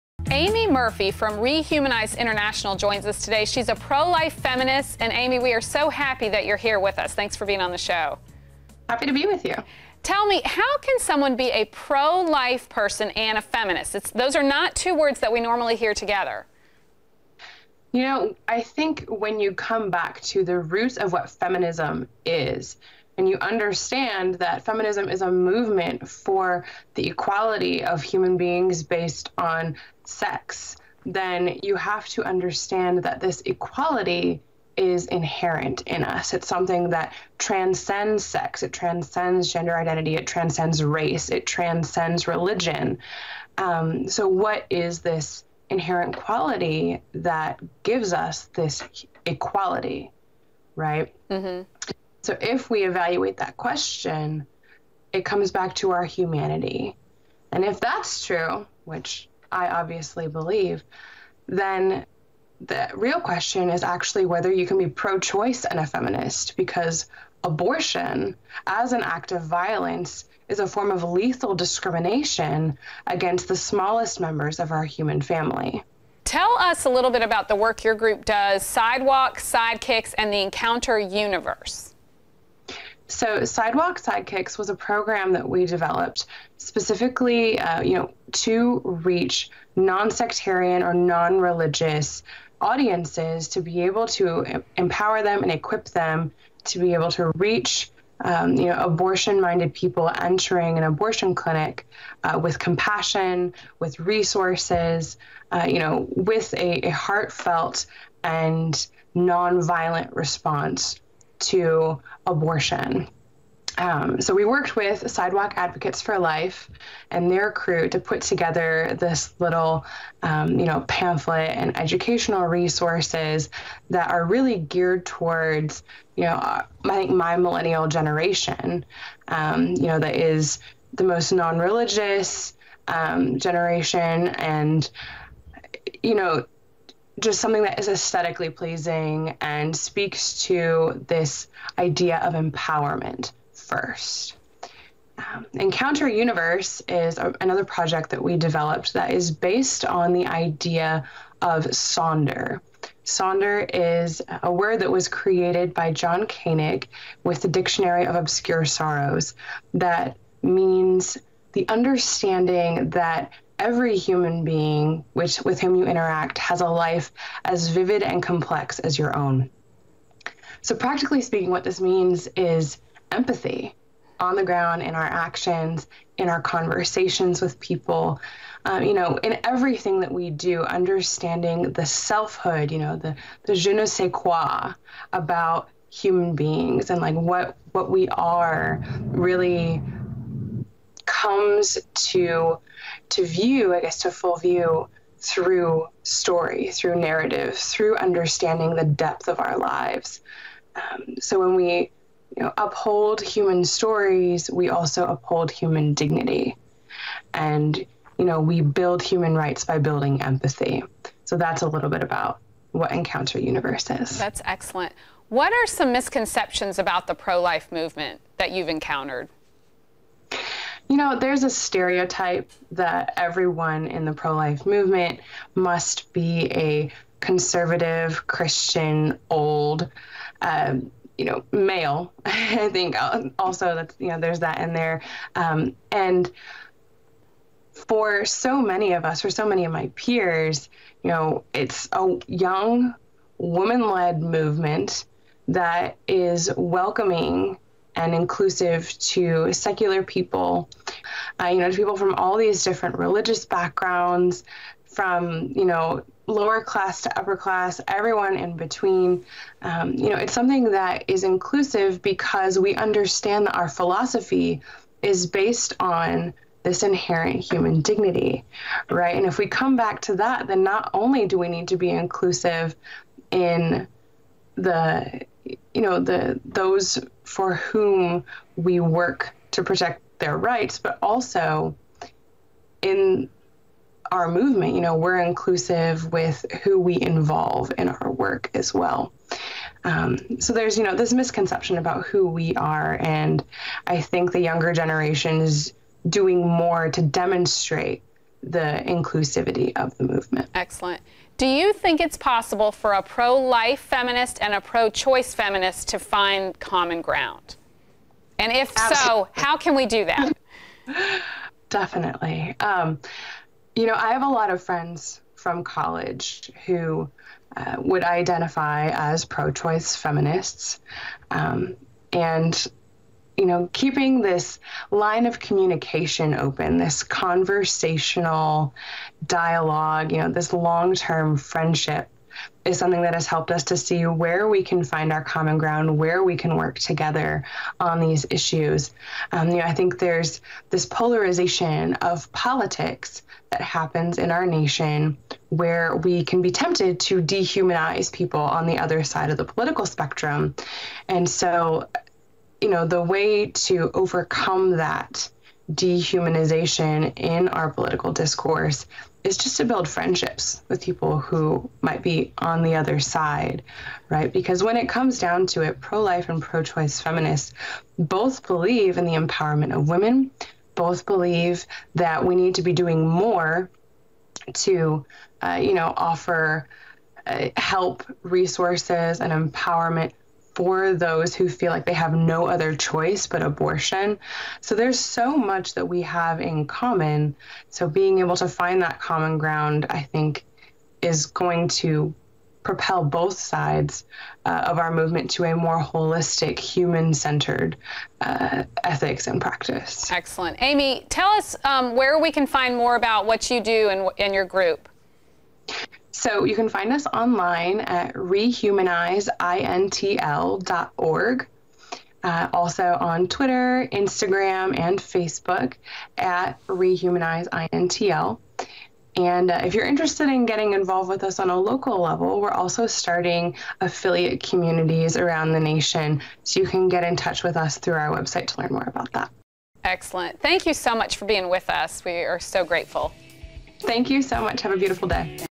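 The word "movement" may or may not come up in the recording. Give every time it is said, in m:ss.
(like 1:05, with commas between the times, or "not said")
0:25, 3:37, 3:44, 4:04, 4:44, 5:00, 6:34.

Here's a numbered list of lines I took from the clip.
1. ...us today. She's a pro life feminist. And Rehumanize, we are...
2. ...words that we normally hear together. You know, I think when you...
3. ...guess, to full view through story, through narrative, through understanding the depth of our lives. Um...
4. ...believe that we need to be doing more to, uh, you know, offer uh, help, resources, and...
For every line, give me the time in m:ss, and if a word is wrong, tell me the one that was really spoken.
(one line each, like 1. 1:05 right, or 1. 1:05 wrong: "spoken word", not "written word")
1. 0:03 wrong: "Aimee", not "Rehumanize"
2. 0:14 right
3. 3:13 right
4. 6:11 right.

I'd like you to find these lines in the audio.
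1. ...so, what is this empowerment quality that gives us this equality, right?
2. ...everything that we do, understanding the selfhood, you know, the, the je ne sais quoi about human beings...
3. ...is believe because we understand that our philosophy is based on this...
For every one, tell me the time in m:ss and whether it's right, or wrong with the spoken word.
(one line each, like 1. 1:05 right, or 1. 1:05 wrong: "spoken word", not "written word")
1. 0:44 wrong: "inherent", not "empowerment"
2. 2:59 right
3. 4:21 wrong: "inclusive", not "believe".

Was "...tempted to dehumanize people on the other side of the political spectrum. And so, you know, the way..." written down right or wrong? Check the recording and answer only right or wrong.
right.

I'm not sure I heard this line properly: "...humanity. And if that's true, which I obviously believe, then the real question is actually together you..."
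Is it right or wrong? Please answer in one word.
wrong.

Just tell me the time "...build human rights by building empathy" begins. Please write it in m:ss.
3:28.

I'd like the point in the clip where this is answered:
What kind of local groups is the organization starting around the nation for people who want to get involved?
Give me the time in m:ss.
7:03.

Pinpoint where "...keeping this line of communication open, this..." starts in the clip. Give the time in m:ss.
5:23.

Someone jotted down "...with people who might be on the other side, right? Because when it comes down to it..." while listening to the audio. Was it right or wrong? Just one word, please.
right.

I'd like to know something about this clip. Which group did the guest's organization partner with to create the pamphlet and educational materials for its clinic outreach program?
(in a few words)
Sidewalk Advocates for Life.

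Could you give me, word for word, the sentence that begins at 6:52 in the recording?
Uh, also on Twitter, Instagram, and Facebook at rehumanizeintl.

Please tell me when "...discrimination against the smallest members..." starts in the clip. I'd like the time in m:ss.
1:11.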